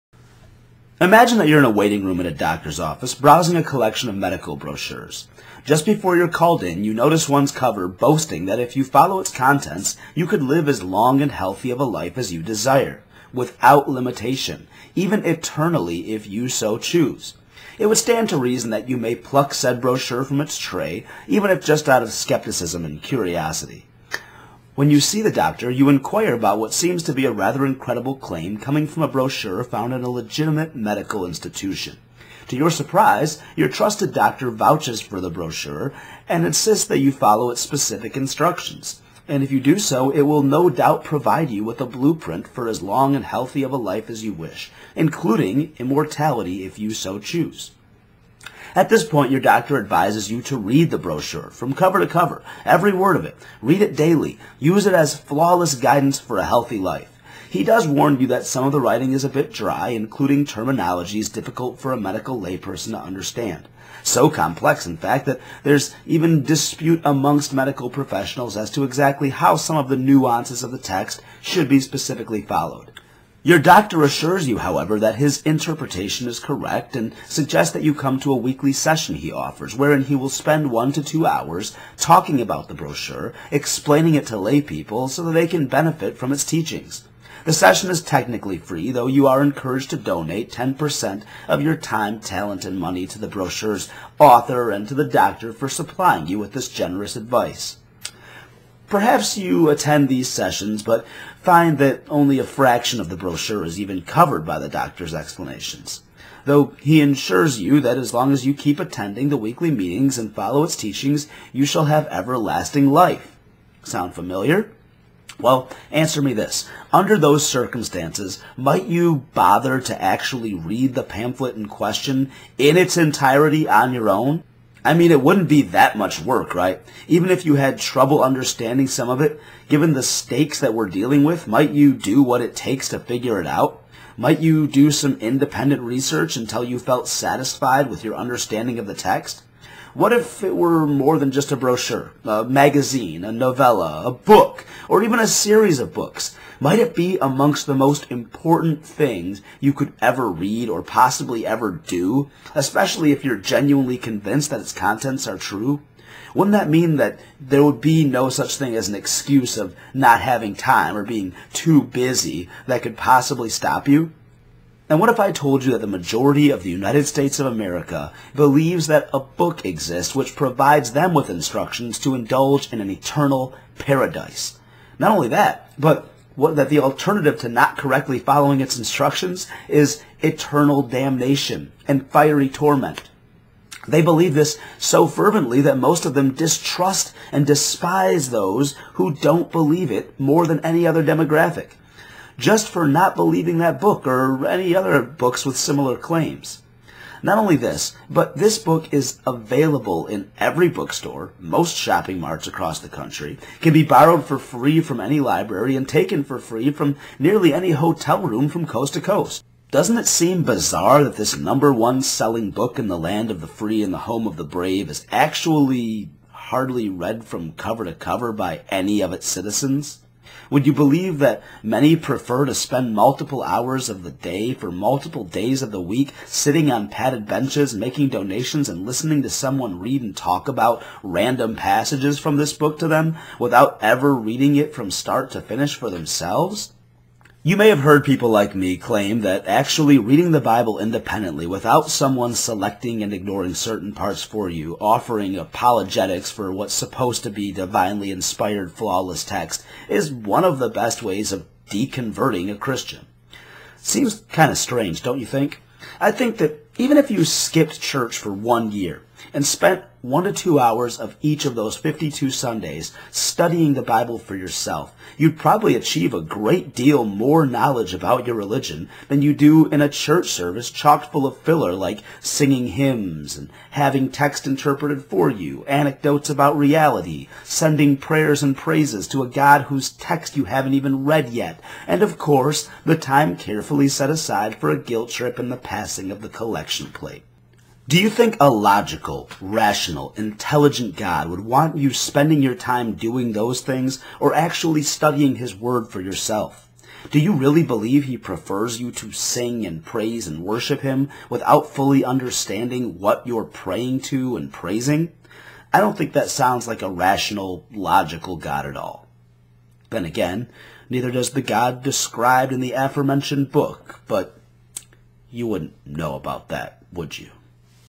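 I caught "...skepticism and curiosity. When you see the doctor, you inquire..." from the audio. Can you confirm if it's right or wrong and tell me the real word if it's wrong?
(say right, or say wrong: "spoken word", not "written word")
right.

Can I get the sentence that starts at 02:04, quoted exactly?
I mean, it wouldn't be that much work, right?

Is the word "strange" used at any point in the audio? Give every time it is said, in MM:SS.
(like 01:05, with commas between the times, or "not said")
04:14.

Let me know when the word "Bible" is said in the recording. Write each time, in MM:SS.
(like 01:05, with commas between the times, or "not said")
04:00, 04:23.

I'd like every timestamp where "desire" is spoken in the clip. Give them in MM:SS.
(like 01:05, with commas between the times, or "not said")
00:12.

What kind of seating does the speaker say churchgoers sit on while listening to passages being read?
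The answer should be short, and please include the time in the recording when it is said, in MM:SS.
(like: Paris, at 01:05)
padded benches, at 03:46.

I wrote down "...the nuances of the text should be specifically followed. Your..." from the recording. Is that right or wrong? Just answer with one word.
right.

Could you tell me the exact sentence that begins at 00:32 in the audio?
To your surprise, your trusted doctor vouches for the brochure and insists that you follow its specific instructions.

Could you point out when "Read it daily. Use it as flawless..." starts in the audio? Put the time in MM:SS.
00:53.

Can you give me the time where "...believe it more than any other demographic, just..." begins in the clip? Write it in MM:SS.
03:09.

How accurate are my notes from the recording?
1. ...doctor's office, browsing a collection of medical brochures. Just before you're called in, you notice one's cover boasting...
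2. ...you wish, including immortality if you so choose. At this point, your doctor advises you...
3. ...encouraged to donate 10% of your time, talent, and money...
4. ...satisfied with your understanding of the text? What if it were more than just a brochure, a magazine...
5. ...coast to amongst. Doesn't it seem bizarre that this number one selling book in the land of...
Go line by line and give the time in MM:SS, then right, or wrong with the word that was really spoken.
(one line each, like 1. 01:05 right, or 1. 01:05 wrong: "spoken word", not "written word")
1. 00:02 right
2. 00:44 right
3. 01:29 right
4. 02:17 right
5. 03:28 wrong: "coast", not "amongst".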